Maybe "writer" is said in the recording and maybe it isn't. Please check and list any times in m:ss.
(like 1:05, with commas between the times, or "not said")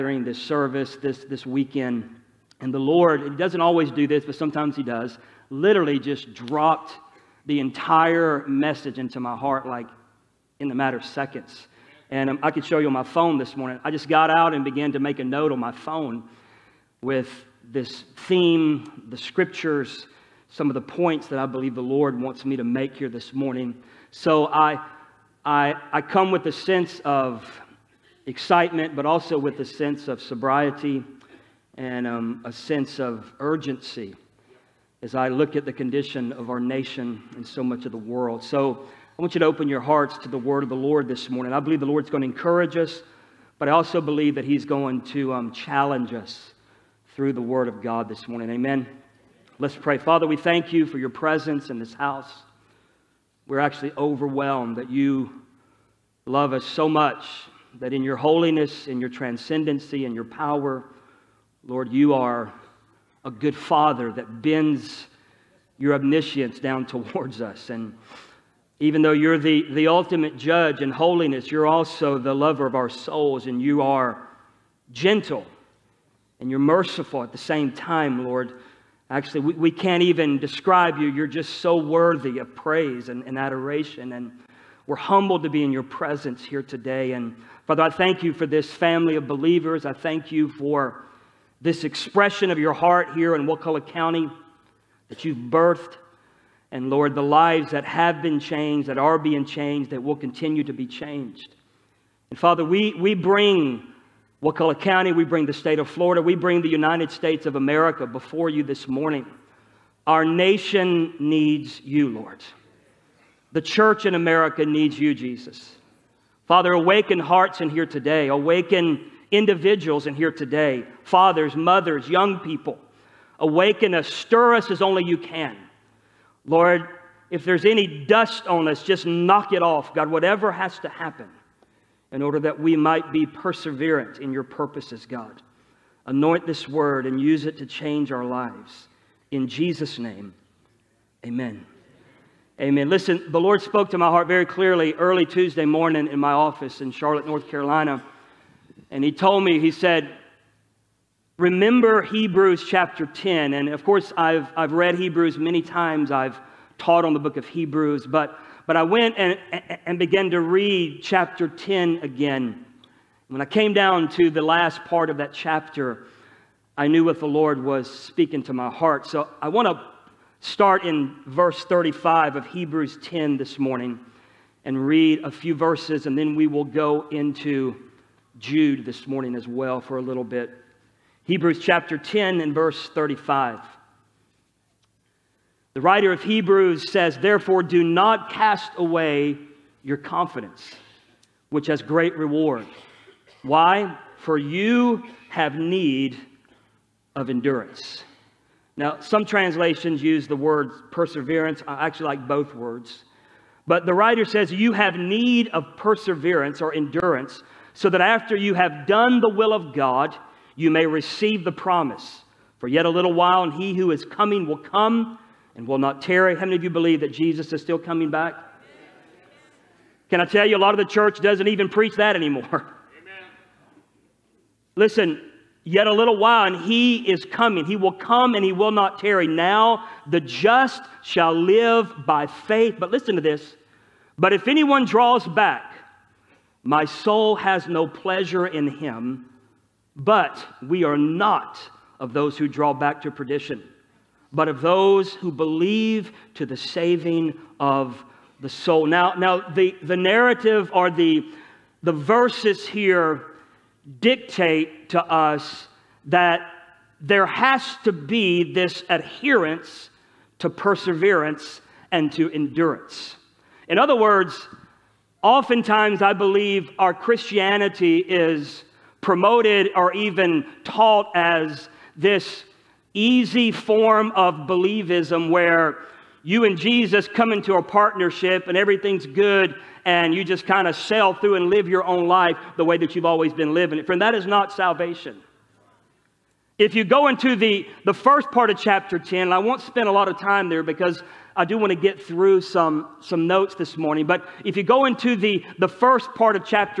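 3:05, 3:23.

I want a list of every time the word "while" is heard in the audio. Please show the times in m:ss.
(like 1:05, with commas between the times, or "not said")
3:33, 3:46.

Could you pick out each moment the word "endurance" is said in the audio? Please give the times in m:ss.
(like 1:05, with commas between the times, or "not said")
3:17, 3:26, 4:22.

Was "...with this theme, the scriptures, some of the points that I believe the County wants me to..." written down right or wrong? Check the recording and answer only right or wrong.
wrong.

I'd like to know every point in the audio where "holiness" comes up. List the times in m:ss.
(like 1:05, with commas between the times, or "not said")
0:58, 1:10.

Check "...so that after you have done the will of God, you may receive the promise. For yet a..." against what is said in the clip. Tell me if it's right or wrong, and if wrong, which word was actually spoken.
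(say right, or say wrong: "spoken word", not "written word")
right.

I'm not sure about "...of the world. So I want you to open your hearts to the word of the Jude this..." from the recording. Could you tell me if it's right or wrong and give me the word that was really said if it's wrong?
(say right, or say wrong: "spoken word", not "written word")
wrong: "Lord", not "Jude".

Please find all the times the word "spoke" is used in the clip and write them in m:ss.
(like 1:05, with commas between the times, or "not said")
2:23.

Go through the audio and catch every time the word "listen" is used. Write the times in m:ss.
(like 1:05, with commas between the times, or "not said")
2:22, 3:44, 3:52.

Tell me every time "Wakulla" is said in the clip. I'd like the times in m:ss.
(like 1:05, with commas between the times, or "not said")
1:33, 1:44.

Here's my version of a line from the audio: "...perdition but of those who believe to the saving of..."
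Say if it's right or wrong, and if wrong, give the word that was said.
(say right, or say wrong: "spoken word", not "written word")
right.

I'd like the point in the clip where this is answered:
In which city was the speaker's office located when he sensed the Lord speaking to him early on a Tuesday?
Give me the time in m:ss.
2:26.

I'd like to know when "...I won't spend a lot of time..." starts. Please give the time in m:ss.
4:49.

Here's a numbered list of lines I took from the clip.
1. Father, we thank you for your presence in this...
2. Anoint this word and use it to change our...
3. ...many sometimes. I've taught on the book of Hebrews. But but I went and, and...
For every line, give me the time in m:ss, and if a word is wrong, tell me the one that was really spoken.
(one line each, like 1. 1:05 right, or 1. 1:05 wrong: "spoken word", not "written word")
1. 0:49 right
2. 2:16 right
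3. 2:35 wrong: "times", not "sometimes".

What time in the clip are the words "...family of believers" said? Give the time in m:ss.
1:28.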